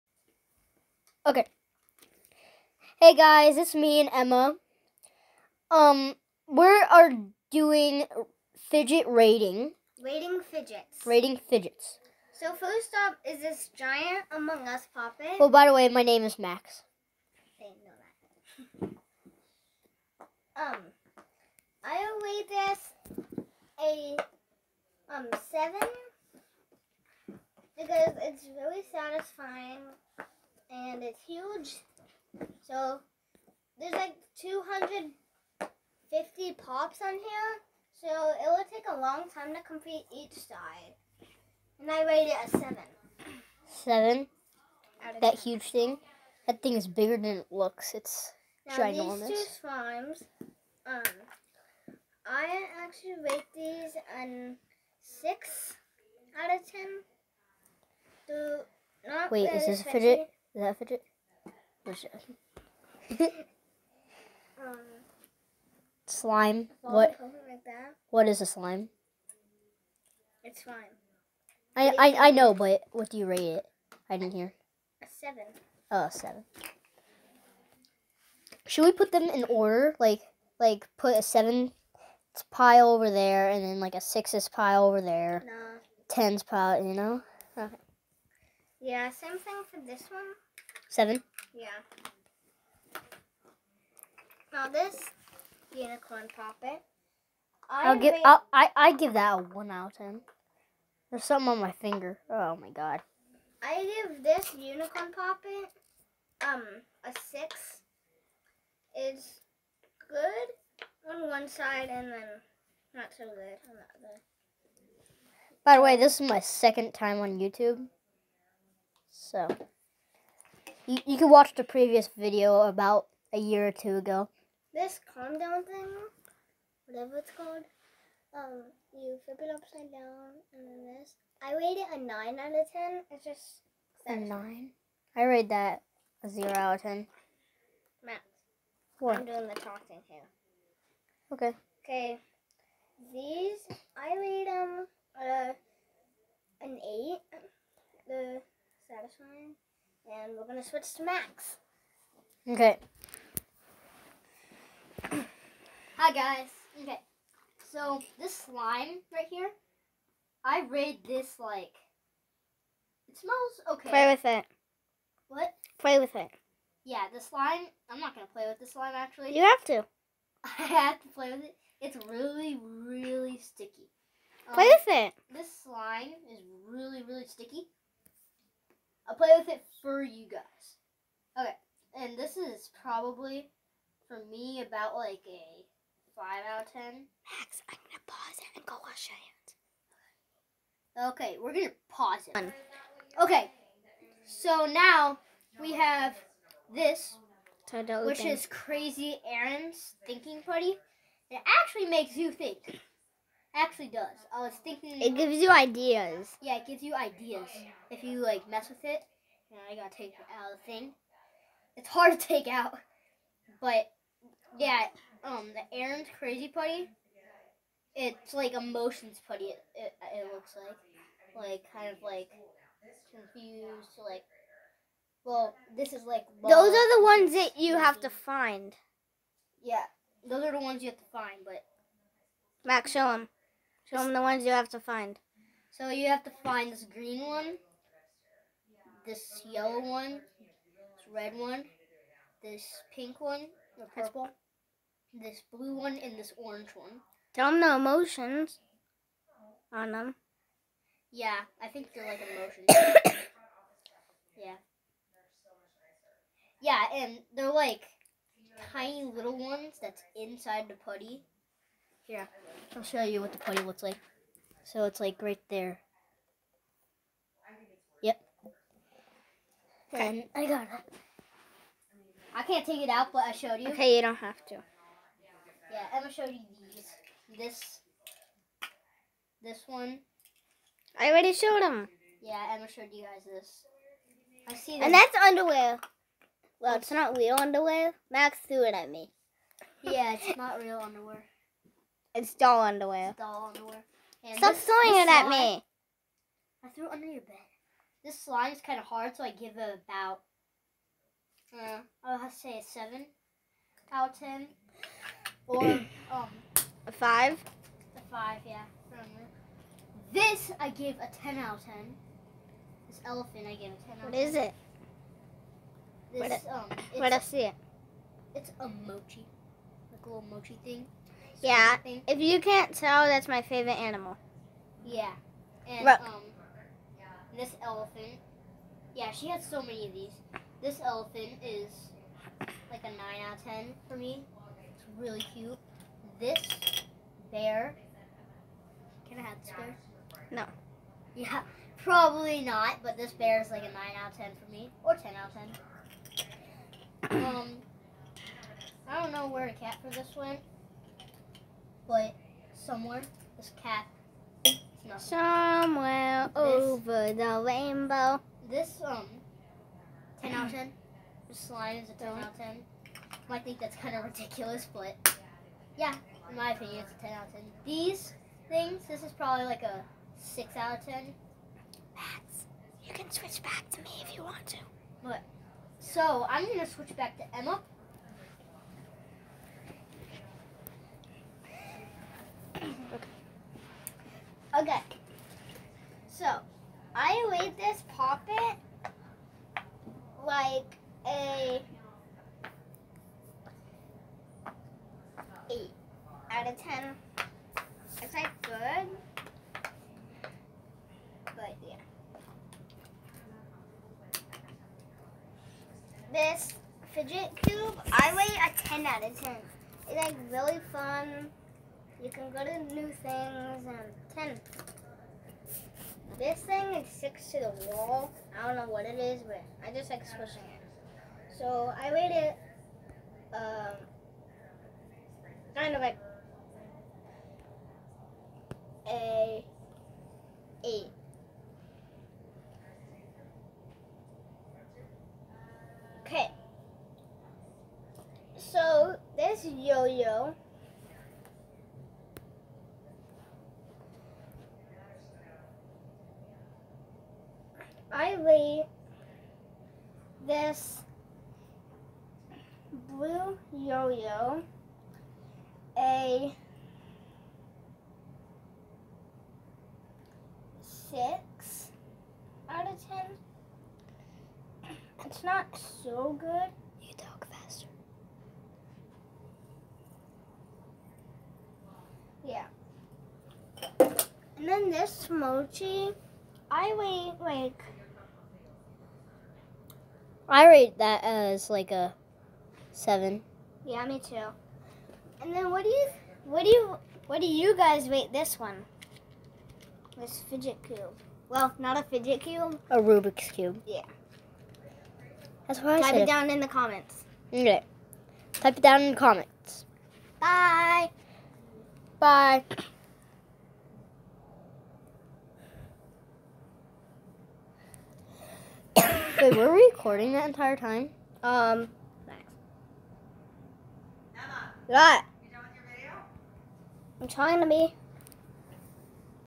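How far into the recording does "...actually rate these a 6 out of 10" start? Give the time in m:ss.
0:52.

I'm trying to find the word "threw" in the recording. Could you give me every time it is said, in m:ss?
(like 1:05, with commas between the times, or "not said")
4:48, 4:56.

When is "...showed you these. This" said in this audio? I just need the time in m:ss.
4:36.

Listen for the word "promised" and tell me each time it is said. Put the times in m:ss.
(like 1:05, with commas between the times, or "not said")
not said.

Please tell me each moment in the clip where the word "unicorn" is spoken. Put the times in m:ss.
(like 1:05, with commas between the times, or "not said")
1:35, 1:44.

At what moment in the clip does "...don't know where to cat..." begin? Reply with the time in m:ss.
5:49.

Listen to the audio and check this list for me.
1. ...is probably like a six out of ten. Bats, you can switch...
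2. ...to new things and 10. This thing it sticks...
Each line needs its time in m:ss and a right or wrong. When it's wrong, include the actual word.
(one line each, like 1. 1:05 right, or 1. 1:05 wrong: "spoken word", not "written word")
1. 6:09 right
2. 6:52 right.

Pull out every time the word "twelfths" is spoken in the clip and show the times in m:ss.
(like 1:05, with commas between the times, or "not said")
not said.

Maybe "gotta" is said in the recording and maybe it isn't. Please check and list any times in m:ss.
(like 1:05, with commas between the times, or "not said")
3:29.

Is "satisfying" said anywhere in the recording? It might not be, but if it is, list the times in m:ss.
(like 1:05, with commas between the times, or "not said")
0:28, 2:28.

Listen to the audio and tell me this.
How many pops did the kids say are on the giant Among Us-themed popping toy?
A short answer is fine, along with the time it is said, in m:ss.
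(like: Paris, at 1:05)
250, at 0:34.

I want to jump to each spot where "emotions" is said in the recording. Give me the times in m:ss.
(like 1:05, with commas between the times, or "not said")
3:38, 4:07, 4:12.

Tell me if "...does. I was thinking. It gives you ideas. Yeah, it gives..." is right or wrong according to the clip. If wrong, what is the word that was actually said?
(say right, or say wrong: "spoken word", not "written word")
right.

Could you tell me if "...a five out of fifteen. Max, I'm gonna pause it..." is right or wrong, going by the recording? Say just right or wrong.
wrong.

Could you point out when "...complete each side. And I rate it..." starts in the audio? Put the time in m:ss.
0:39.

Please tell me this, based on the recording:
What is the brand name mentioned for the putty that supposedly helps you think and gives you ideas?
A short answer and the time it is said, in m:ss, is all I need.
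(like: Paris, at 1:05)
Crazy Aaron's, at 3:18.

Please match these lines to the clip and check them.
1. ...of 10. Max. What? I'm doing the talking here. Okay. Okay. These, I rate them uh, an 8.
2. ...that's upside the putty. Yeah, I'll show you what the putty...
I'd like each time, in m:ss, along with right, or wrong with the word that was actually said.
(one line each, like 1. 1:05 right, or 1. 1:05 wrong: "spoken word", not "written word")
1. 2:16 right
2. 4:19 wrong: "inside", not "upside".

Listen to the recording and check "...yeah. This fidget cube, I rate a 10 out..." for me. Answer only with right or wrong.
right.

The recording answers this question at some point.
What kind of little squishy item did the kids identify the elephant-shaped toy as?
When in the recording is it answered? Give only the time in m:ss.
5:18.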